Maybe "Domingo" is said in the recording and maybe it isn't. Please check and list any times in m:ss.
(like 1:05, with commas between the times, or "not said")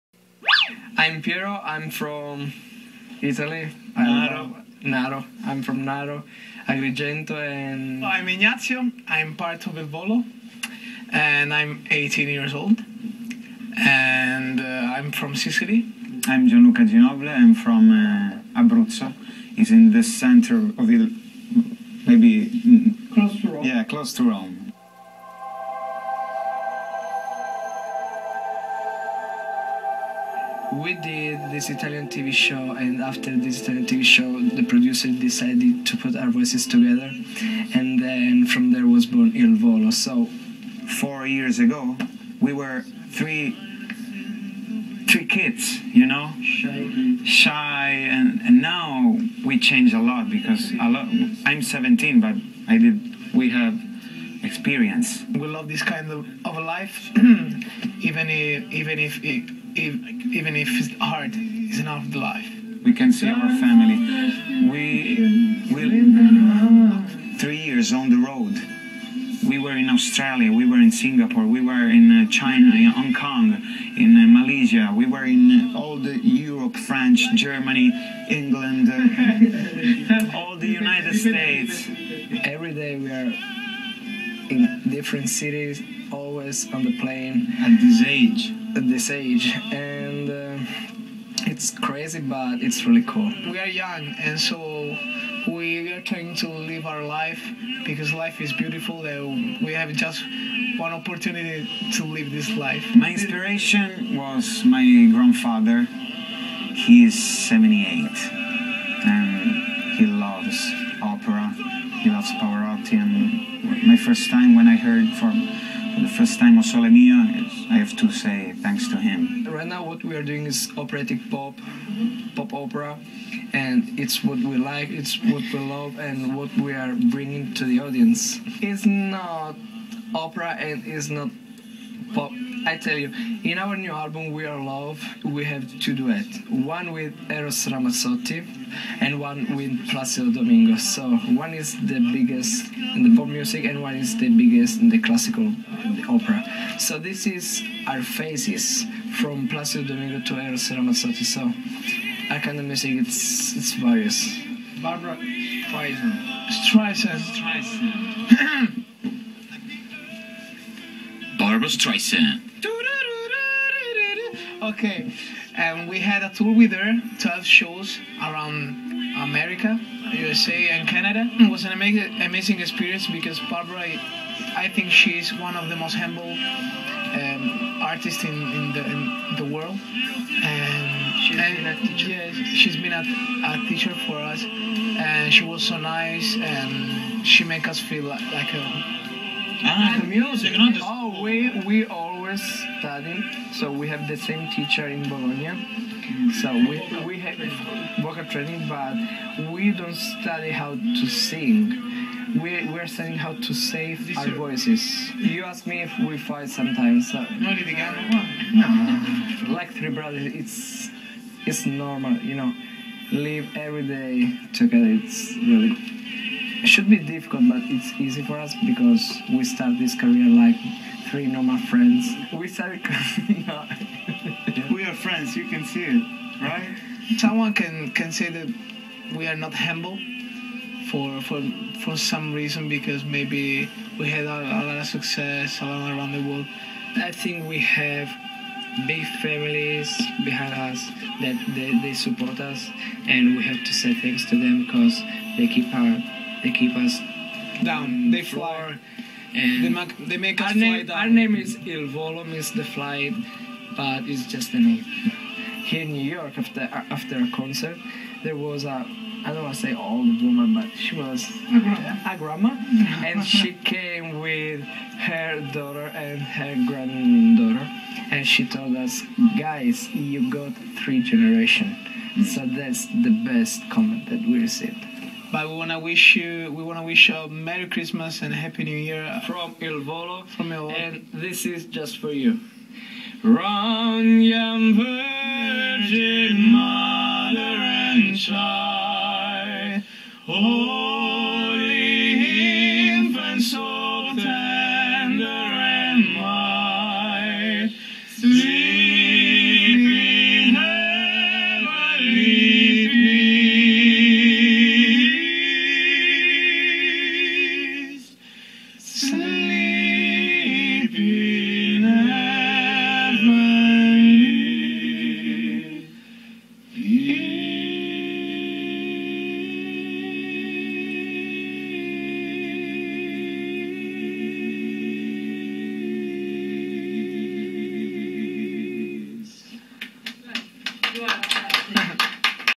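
2:20, 2:29.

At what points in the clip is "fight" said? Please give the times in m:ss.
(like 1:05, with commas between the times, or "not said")
3:26.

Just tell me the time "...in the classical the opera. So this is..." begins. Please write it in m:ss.
2:24.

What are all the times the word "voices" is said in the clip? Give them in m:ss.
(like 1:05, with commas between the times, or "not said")
0:36, 3:24.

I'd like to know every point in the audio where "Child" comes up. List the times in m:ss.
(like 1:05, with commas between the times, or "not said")
4:48.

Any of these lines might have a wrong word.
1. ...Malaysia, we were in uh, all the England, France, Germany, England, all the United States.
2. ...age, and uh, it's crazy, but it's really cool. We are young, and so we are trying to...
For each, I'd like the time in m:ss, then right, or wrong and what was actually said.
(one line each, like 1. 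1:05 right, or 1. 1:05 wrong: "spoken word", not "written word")
1. 1:14 wrong: "Europe", not "England"
2. 1:29 right.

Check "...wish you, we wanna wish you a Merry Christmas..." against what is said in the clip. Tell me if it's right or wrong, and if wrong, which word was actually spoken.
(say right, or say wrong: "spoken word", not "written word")
right.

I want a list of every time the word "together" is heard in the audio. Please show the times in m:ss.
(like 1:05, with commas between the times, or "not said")
0:36, 3:34.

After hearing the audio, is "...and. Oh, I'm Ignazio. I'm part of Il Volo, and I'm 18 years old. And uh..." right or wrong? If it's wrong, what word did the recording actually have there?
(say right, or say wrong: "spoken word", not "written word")
right.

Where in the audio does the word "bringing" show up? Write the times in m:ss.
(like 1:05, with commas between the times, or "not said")
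2:06.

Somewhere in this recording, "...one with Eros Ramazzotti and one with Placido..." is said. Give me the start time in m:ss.
2:16.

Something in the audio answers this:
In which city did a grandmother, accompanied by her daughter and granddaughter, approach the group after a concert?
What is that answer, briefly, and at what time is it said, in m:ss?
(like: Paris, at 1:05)
New York, at 4:15.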